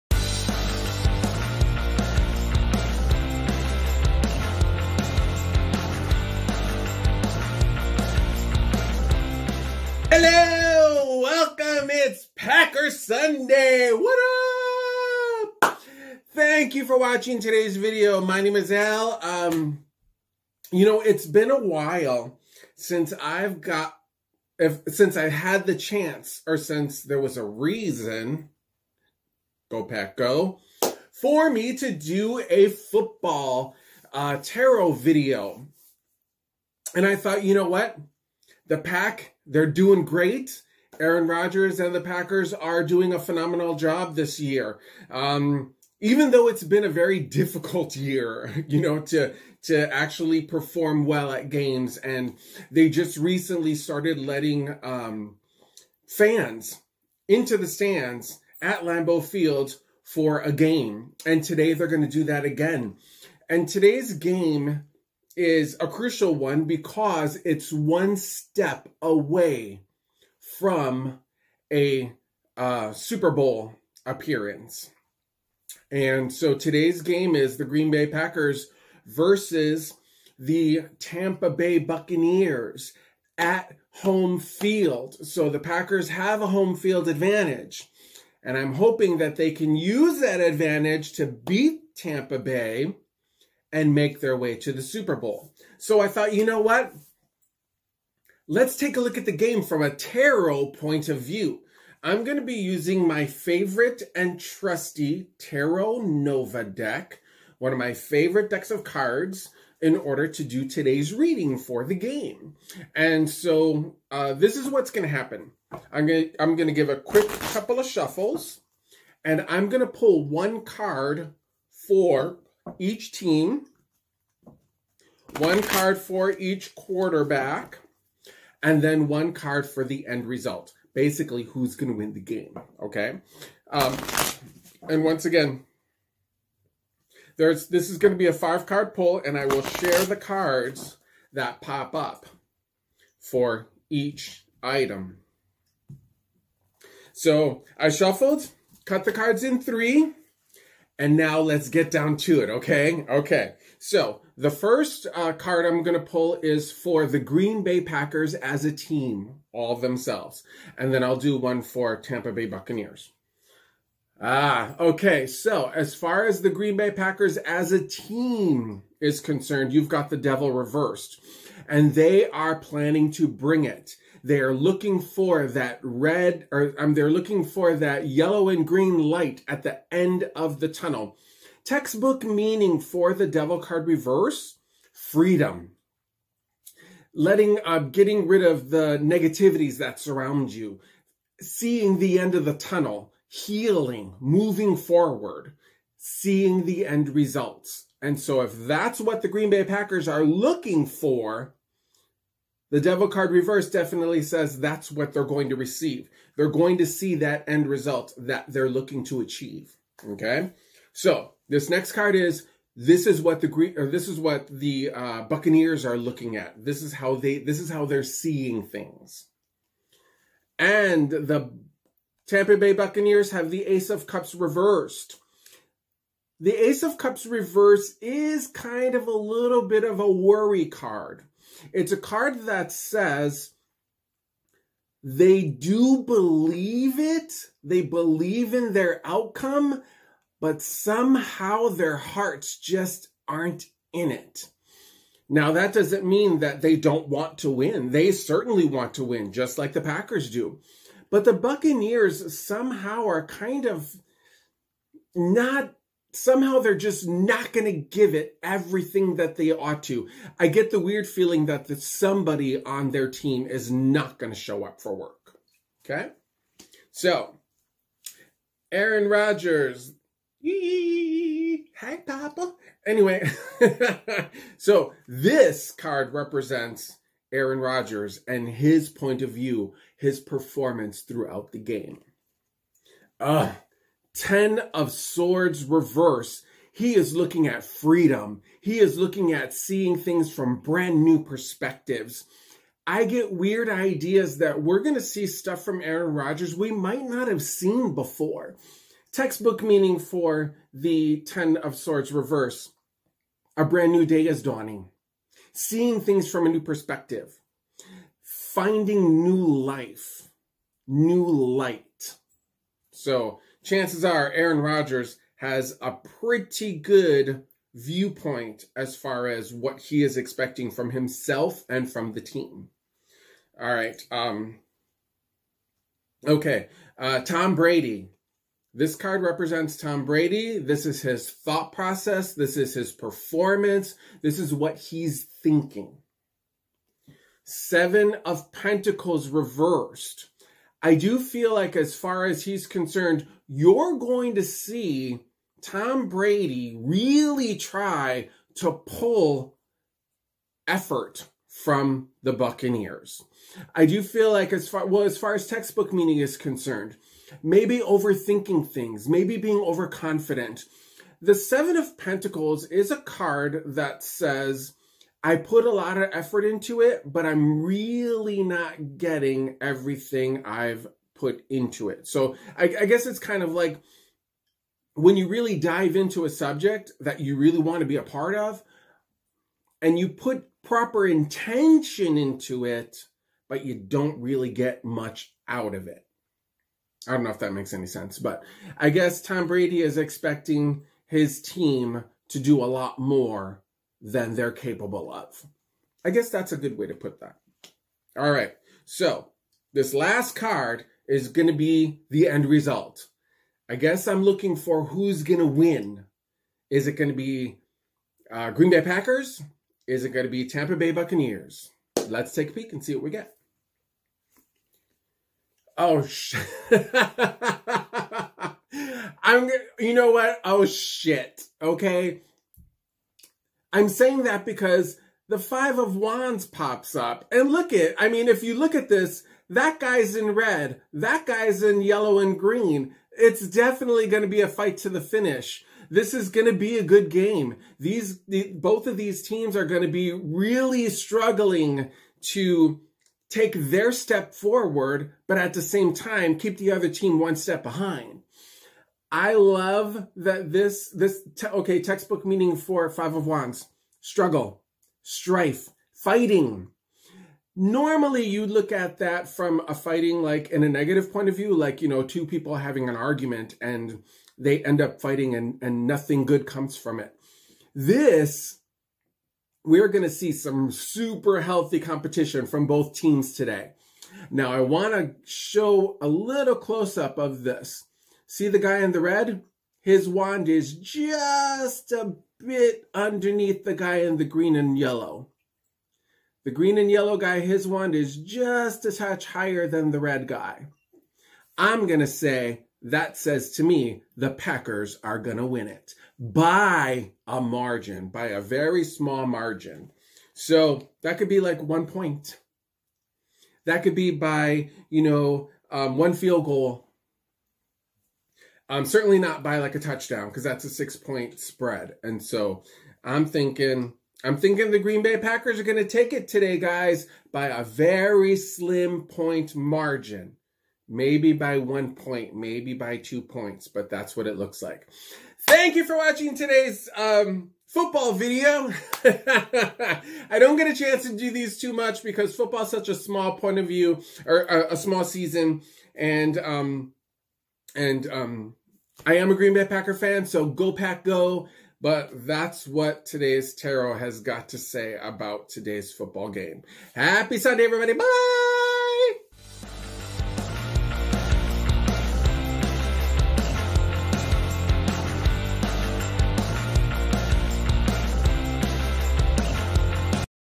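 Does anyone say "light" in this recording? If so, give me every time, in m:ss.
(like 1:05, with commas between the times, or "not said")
2:58, 5:11.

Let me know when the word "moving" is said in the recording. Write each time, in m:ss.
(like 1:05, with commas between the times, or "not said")
3:14.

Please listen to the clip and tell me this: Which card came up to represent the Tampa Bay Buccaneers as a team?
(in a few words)
Ace of Cups reversed.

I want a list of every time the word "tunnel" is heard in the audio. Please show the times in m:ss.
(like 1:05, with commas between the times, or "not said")
3:00, 3:12.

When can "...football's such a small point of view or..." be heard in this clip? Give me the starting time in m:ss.
8:52.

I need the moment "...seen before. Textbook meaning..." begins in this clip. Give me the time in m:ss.
4:57.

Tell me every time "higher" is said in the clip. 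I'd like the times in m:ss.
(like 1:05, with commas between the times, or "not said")
8:09.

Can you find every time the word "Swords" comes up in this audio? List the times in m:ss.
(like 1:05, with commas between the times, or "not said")
4:44, 5:01.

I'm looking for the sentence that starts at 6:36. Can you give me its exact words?
I guess that's a good way to put that.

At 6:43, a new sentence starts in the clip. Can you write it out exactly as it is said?
I guess I'm looking for who's going to win.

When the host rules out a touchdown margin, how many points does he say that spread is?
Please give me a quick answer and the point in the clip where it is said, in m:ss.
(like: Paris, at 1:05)
6, at 8:30.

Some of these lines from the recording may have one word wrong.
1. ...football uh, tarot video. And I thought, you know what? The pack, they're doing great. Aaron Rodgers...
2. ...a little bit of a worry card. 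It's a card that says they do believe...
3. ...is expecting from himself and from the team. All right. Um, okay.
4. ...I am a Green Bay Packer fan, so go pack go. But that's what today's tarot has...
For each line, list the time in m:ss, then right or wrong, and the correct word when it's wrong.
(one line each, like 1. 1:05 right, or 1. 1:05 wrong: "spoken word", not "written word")
1. 0:32 right
2. 3:49 right
3. 5:20 right
4. 8:59 right.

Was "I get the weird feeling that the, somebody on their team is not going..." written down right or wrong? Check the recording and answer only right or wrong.
right.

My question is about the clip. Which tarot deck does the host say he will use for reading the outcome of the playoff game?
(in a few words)
Tarot Nova.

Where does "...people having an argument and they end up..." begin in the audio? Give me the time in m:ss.
7:42.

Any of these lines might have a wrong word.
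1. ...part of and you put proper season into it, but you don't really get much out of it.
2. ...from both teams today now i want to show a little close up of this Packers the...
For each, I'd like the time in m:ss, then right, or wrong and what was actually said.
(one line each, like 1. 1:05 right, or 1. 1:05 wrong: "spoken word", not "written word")
1. 6:18 wrong: "intention", not "season"
2. 7:52 wrong: "See", not "Packers".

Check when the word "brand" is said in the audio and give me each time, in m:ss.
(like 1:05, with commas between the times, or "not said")
4:50, 5:03.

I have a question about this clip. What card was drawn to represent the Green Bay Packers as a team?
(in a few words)
The Devil reversed.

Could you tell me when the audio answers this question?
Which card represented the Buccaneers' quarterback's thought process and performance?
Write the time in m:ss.
5:37.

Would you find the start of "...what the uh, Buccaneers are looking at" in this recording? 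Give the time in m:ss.
3:34.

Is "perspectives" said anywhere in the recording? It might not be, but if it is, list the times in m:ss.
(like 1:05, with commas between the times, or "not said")
4:51, 5:06.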